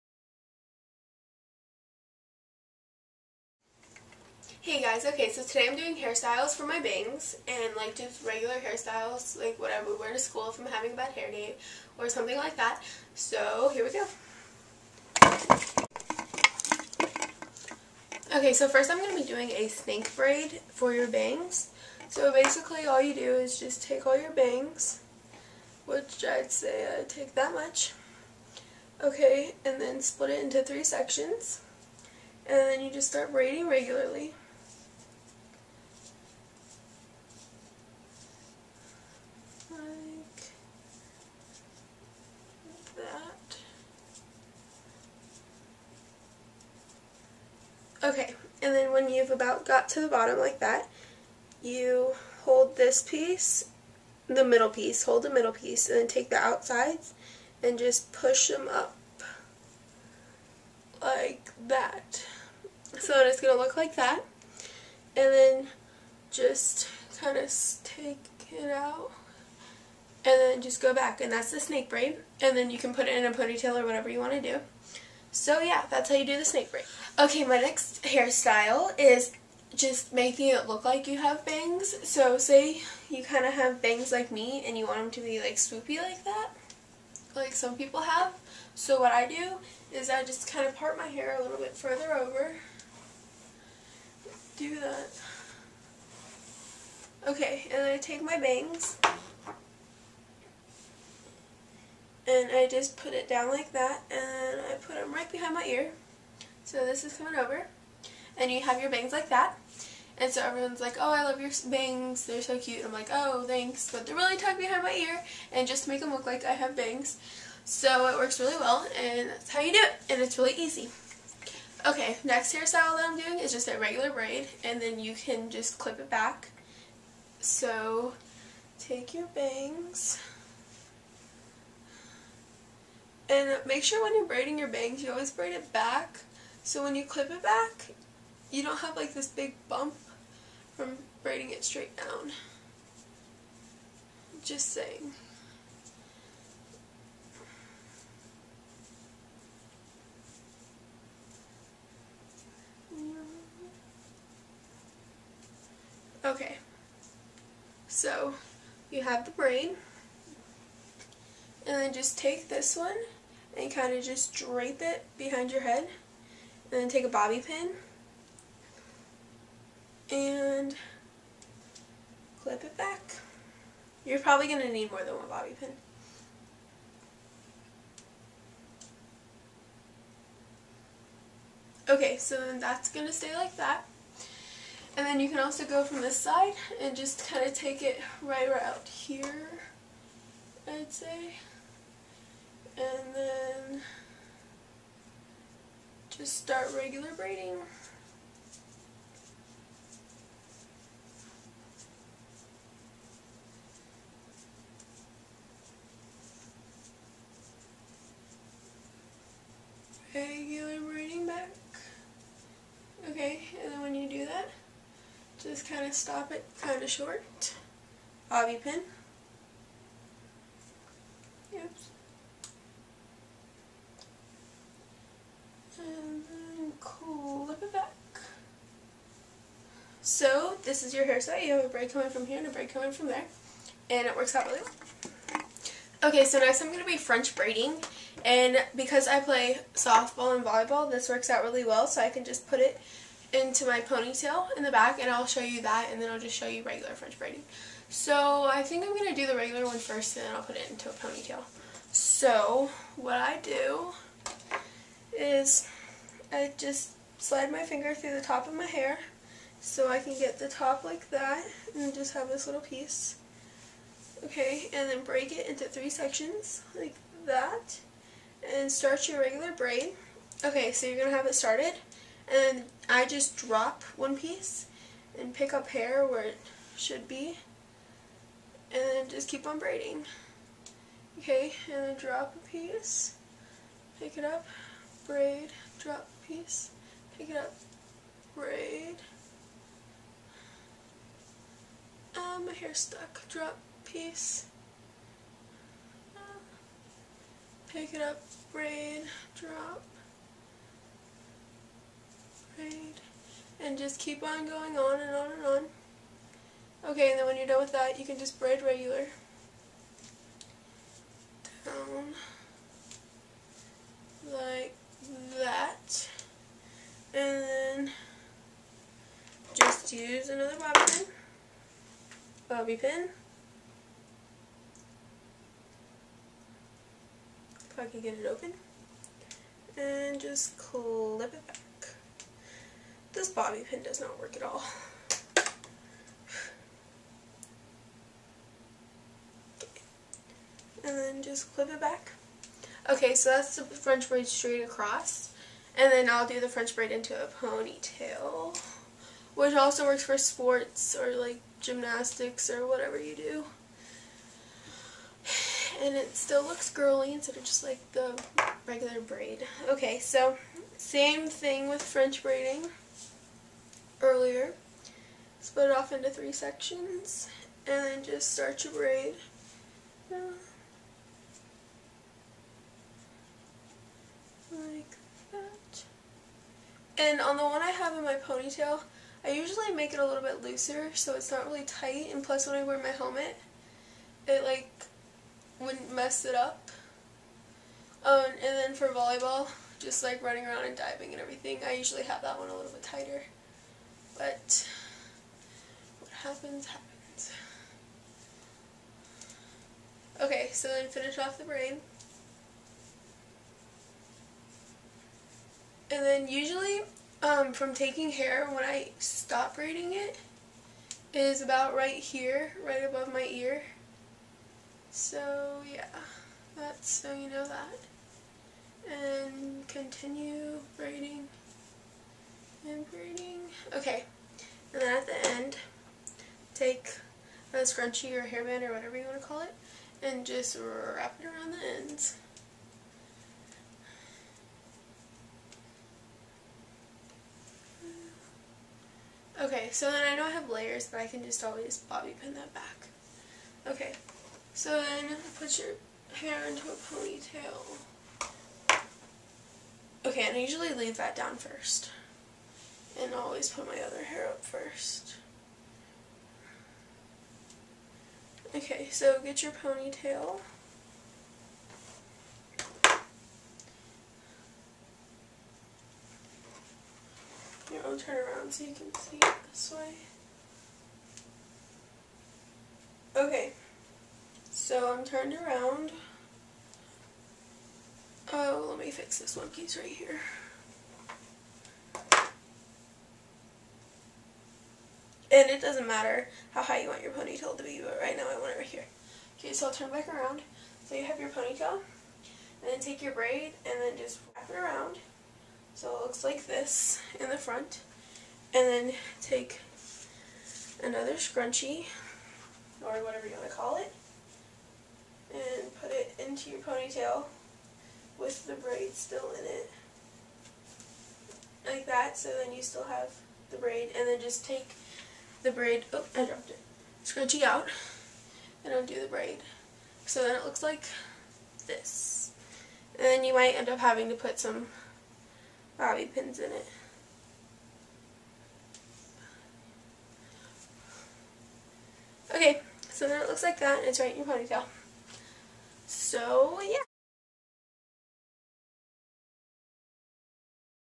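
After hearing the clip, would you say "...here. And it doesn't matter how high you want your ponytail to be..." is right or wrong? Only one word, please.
right.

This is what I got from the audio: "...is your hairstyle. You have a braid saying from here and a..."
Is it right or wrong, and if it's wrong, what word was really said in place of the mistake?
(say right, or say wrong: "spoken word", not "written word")
wrong: "coming", not "saying".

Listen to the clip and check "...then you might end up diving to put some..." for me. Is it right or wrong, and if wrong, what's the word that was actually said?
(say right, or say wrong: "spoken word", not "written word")
wrong: "having", not "diving".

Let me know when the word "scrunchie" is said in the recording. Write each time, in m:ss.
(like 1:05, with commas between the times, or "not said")
7:07, 8:21, 8:37.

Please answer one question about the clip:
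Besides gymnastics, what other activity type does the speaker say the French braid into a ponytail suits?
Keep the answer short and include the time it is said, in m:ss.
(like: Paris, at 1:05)
sports, at 5:50.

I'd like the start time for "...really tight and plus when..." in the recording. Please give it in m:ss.
6:21.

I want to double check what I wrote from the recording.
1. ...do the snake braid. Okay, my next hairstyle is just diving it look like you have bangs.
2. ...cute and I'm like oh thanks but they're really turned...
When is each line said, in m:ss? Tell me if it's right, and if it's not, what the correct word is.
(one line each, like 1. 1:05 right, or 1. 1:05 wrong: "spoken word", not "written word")
1. 1:16 wrong: "making", not "diving"
2. 1:52 wrong: "tucked", not "turned".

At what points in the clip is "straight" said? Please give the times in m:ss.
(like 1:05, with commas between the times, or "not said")
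2:21, 5:44.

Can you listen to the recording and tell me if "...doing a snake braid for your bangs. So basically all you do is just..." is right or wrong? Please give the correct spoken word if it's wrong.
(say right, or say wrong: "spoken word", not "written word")
right.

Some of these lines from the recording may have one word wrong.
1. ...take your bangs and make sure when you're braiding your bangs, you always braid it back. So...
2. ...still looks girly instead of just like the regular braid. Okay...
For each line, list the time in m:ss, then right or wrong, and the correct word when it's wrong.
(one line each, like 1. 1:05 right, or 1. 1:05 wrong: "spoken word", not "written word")
1. 2:08 right
2. 5:56 right.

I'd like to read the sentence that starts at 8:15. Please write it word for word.
So it looks like this in the front.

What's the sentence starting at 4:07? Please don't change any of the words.
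So I think I'm going to do the regular one first and then I'll put it into a ponytail.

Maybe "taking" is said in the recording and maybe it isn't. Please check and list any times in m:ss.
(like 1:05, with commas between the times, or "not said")
6:47.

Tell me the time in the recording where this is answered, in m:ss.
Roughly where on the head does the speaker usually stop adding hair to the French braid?
6:52.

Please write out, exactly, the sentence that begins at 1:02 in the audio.
So it's going to look like that.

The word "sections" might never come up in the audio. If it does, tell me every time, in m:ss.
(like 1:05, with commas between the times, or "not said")
0:30, 4:25, 6:06.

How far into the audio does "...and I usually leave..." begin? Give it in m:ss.
7:30.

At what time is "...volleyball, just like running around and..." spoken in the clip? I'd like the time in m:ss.
6:28.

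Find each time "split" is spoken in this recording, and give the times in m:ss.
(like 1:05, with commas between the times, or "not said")
0:30, 6:05.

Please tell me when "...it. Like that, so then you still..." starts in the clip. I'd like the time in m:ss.
8:29.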